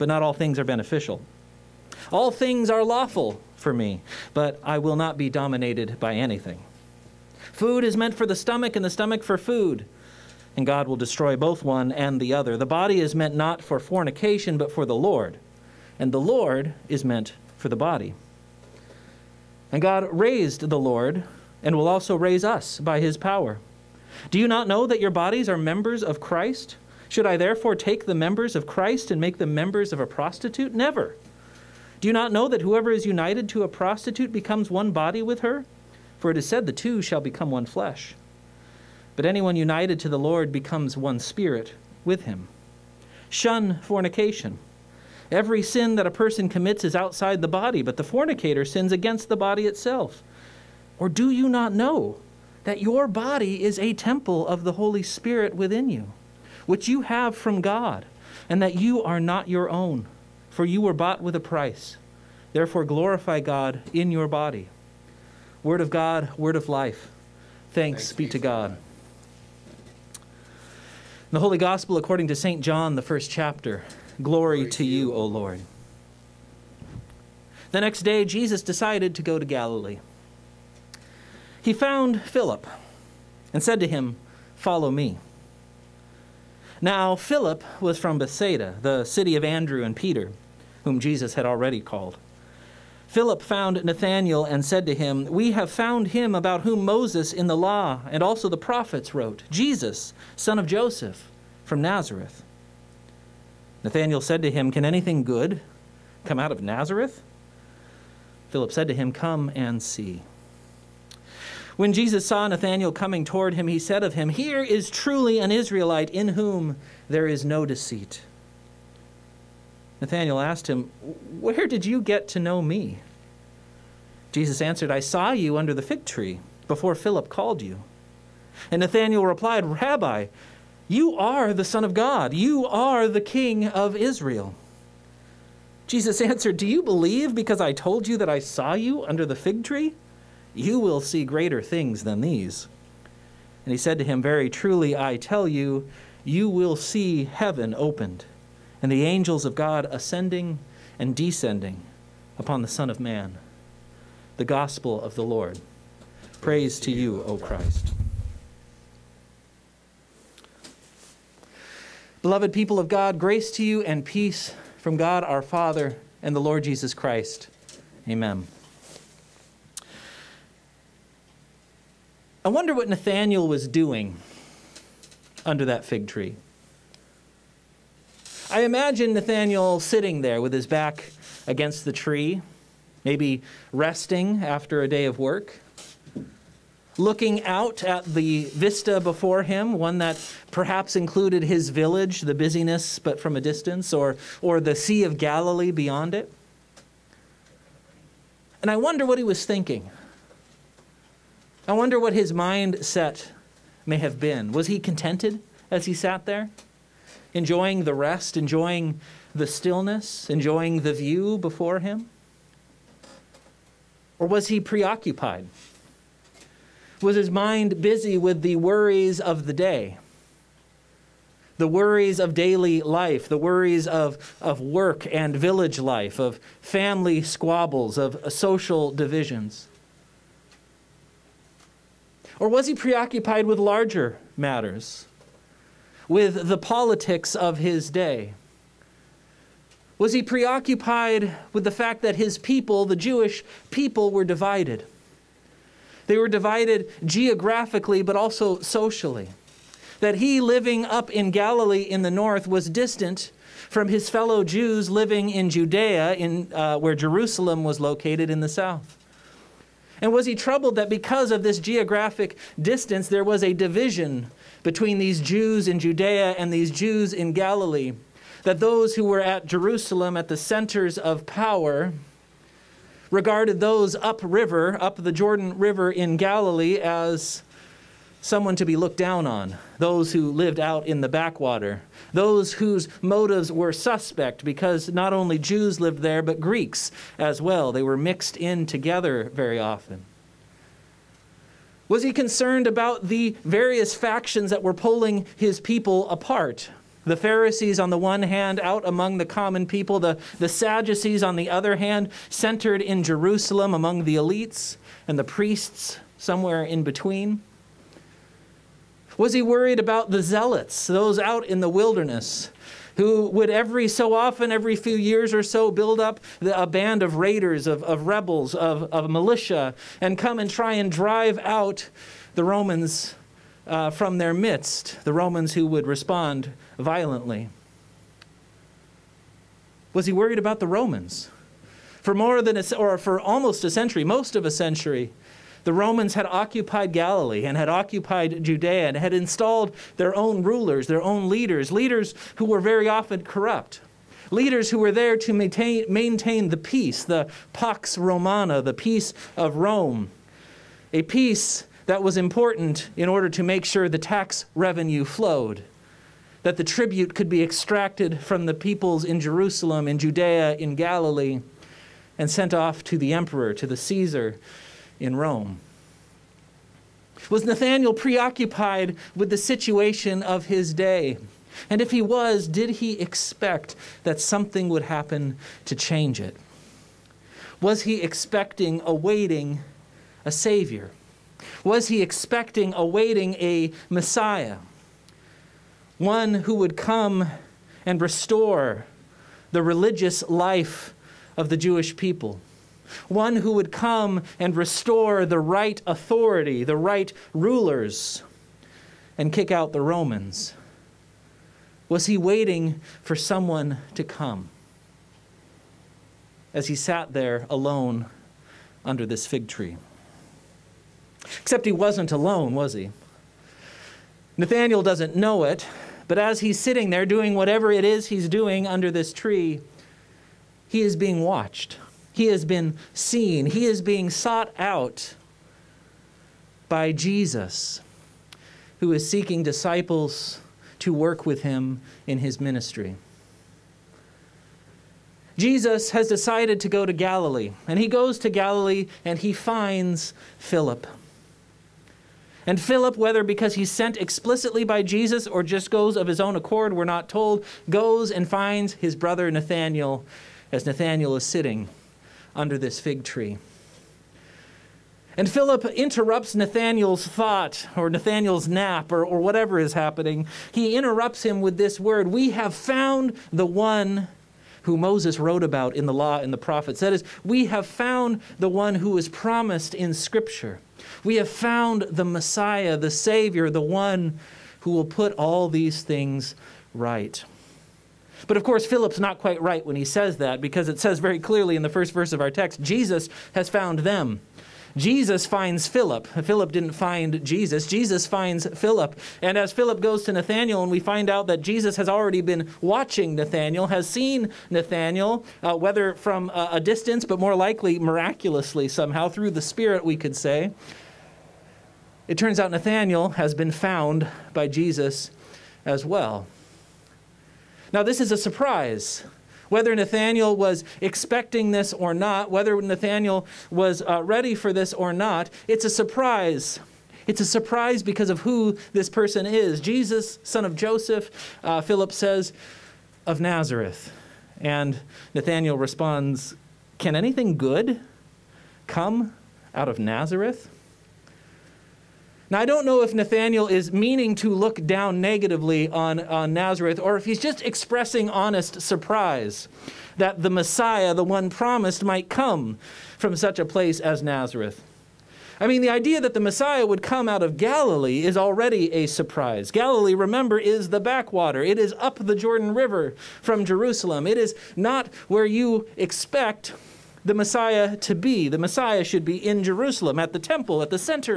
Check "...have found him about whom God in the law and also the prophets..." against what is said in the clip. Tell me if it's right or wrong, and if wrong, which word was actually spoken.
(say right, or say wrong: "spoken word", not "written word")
wrong: "Moses", not "God".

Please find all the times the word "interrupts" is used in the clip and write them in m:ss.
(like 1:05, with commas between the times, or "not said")
7:35, 7:40.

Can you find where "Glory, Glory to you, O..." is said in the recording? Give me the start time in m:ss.
1:14.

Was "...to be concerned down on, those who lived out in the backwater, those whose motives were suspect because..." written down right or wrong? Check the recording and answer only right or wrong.
wrong.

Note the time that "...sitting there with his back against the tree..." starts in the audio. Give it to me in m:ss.
2:59.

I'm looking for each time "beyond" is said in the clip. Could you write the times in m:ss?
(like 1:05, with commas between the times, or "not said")
3:15.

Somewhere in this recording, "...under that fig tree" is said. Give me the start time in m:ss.
2:55.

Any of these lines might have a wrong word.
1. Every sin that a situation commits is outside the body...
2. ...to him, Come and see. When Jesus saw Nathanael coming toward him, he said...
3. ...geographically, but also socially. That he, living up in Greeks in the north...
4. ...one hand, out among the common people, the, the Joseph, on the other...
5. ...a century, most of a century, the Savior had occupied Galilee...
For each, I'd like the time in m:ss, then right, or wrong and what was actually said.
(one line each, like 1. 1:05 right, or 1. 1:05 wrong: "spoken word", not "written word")
1. 0:45 wrong: "person", not "situation"
2. 1:48 right
3. 4:07 wrong: "Galilee", not "Greeks"
4. 4:57 wrong: "Sadducees", not "Joseph"
5. 5:33 wrong: "Romans", not "Savior".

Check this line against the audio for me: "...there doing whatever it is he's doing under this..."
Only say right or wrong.
right.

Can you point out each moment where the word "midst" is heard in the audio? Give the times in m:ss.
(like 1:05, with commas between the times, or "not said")
5:24.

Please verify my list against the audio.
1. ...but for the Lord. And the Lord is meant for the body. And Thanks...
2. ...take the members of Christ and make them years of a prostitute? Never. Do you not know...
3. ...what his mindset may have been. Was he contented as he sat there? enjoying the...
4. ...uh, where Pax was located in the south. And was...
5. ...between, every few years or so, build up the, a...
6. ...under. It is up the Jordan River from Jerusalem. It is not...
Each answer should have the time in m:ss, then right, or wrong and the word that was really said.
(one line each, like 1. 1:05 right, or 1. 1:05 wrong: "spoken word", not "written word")
1. 0:14 wrong: "God", not "Thanks"
2. 0:27 wrong: "members", not "years"
3. 3:21 right
4. 4:16 wrong: "Jerusalem", not "Pax"
5. 5:14 wrong: "often", not "between"
6. 9:10 wrong: "backwater", not "under".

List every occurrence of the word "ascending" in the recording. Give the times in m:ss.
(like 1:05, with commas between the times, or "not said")
2:29.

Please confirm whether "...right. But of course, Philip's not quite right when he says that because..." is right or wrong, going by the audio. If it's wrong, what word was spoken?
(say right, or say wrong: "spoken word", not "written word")
right.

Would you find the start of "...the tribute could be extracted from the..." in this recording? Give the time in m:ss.
5:56.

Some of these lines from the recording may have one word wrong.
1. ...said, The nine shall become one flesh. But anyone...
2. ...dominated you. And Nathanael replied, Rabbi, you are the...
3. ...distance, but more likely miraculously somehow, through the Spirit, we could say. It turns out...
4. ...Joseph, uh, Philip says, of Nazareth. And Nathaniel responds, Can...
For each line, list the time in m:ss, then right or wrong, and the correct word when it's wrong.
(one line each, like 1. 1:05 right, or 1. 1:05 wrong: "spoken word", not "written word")
1. 0:36 wrong: "two", not "nine"
2. 2:07 wrong: "called", not "dominated"
3. 8:16 right
4. 8:40 right.